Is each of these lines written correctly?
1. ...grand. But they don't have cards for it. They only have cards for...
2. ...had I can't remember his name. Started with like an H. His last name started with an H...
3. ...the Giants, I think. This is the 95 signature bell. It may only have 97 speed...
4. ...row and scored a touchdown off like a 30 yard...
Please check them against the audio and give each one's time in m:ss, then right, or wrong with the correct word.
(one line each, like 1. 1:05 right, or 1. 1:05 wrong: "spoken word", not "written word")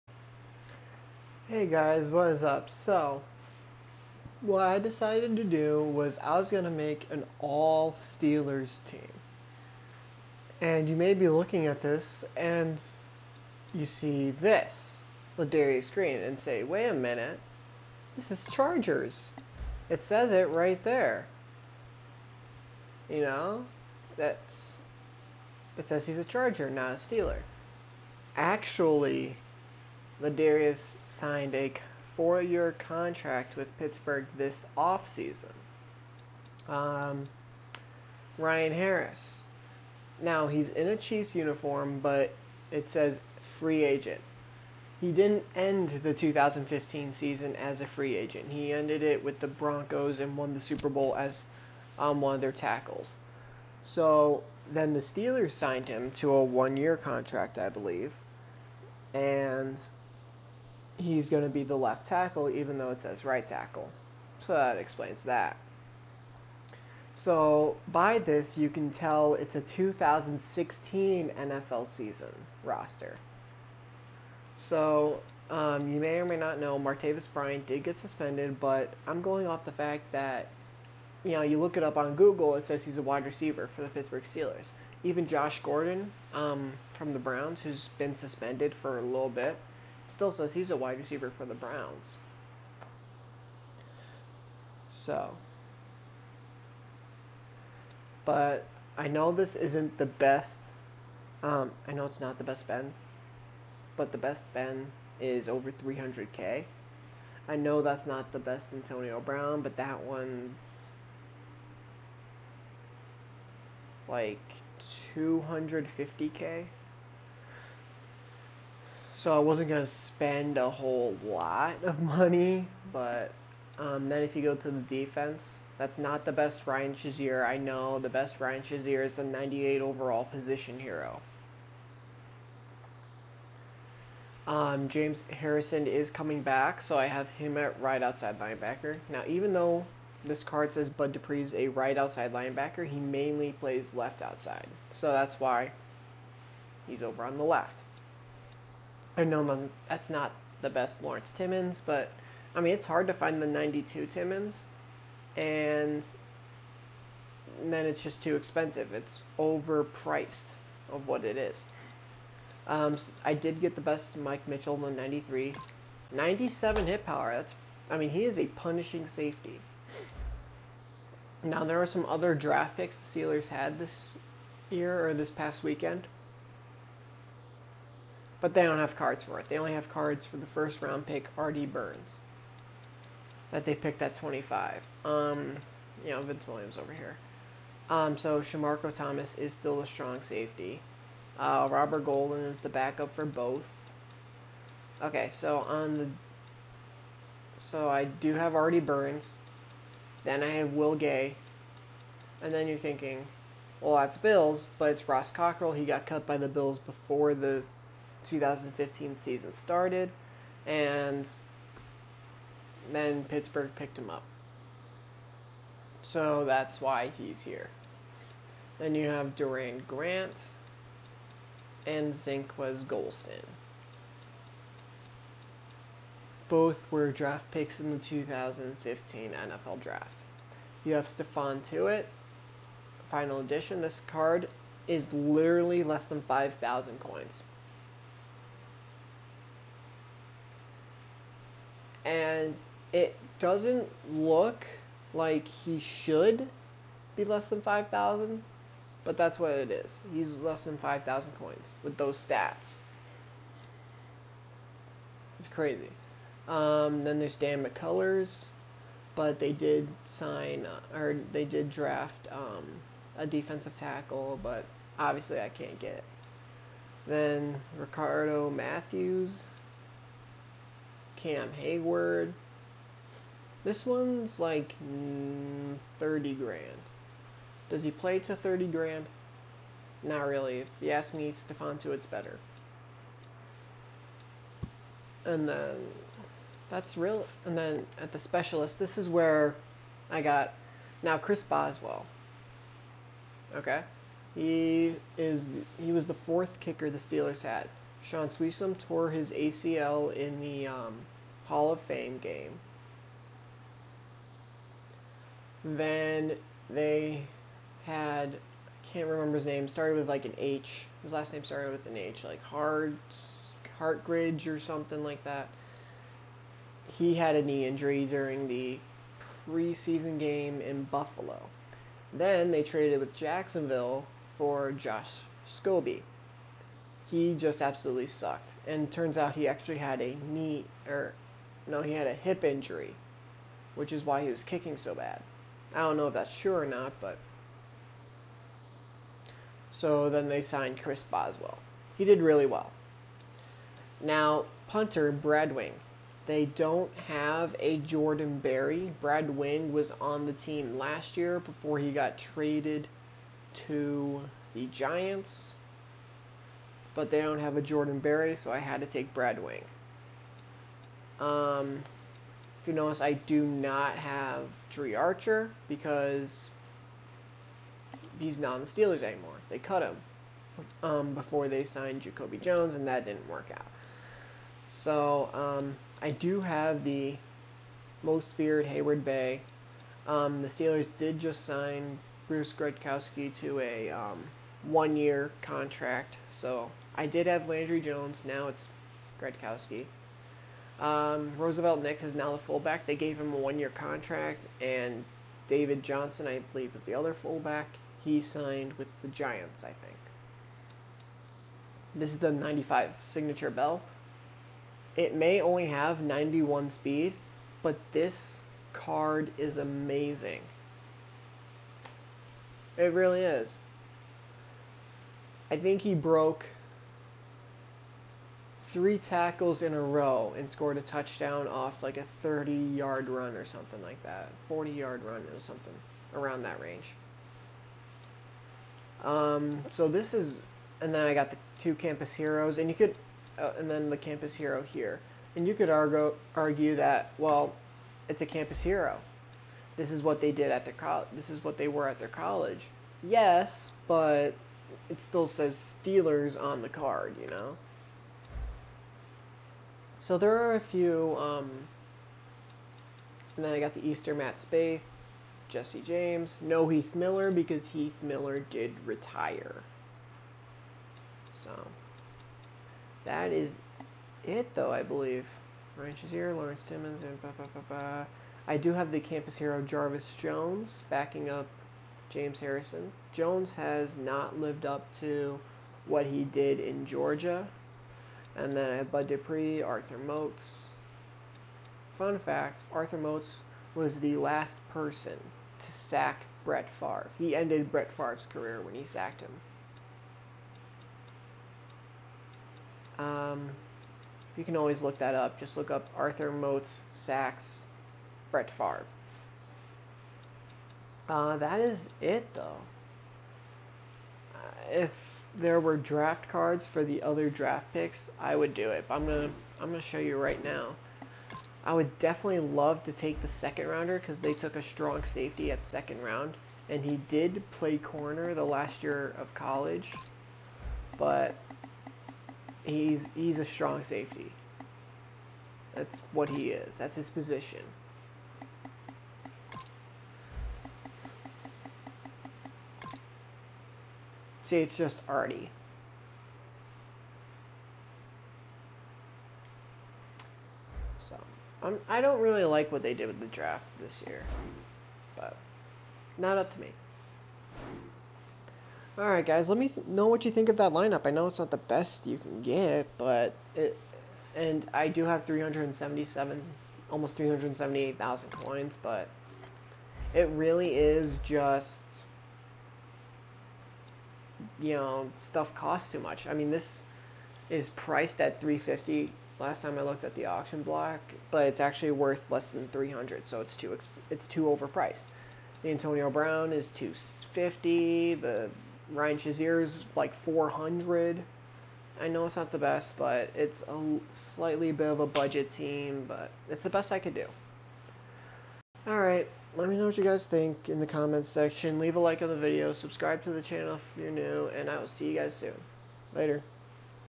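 1. 2:55 wrong: "weekend", not "grand"
2. 5:07 right
3. 6:39 wrong: "91", not "97"
4. 6:59 right.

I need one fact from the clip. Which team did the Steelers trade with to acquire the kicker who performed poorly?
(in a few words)
Jacksonville.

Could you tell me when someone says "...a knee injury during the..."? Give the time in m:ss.
5:17.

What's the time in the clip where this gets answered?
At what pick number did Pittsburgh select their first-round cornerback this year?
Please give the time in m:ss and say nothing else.
3:04.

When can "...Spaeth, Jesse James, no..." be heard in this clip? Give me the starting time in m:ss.
7:34.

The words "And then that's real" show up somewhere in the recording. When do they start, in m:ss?
4:45.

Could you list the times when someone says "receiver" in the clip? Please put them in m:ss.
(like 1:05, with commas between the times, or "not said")
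1:23, 1:30.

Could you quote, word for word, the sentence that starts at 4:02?
and it doesn't look like he should be less than 5,000, but that's what it is.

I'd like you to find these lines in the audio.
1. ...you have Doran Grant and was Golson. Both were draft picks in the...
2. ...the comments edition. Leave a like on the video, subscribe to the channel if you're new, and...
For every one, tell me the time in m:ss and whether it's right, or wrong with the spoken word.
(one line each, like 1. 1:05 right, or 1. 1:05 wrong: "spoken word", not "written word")
1. 3:38 right
2. 9:50 wrong: "section", not "edition".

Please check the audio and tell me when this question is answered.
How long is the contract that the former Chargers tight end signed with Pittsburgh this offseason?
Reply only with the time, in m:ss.
0:32.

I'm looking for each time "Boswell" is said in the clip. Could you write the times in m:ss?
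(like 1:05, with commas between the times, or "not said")
4:51, 5:41.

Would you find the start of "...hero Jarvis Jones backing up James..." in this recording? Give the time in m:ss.
7:49.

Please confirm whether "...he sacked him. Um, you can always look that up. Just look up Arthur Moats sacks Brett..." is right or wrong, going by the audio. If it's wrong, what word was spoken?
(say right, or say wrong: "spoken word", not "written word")
right.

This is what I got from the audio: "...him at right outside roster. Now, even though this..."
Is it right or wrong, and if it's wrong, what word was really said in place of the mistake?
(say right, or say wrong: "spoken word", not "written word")
wrong: "linebacker", not "roster".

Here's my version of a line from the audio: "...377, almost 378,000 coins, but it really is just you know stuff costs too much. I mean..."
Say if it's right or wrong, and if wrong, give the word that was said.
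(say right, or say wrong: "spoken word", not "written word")
right.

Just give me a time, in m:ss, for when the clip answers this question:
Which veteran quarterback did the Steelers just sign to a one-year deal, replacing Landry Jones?
6:22.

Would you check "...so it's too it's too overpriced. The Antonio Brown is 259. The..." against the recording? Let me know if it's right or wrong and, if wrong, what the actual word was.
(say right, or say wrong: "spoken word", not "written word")
wrong: "250", not "259".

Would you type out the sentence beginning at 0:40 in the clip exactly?
Now, he's in a Chiefs uniform, but it says free agent.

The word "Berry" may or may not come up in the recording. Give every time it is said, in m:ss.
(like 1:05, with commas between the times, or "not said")
5:48, 5:57.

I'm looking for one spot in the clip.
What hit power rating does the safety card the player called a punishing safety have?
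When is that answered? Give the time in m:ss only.
2:46.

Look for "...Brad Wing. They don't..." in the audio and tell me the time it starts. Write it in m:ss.
5:45.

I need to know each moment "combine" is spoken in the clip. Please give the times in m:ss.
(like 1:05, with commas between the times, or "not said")
not said.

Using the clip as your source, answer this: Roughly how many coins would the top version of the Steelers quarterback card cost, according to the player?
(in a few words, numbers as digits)
over 300K.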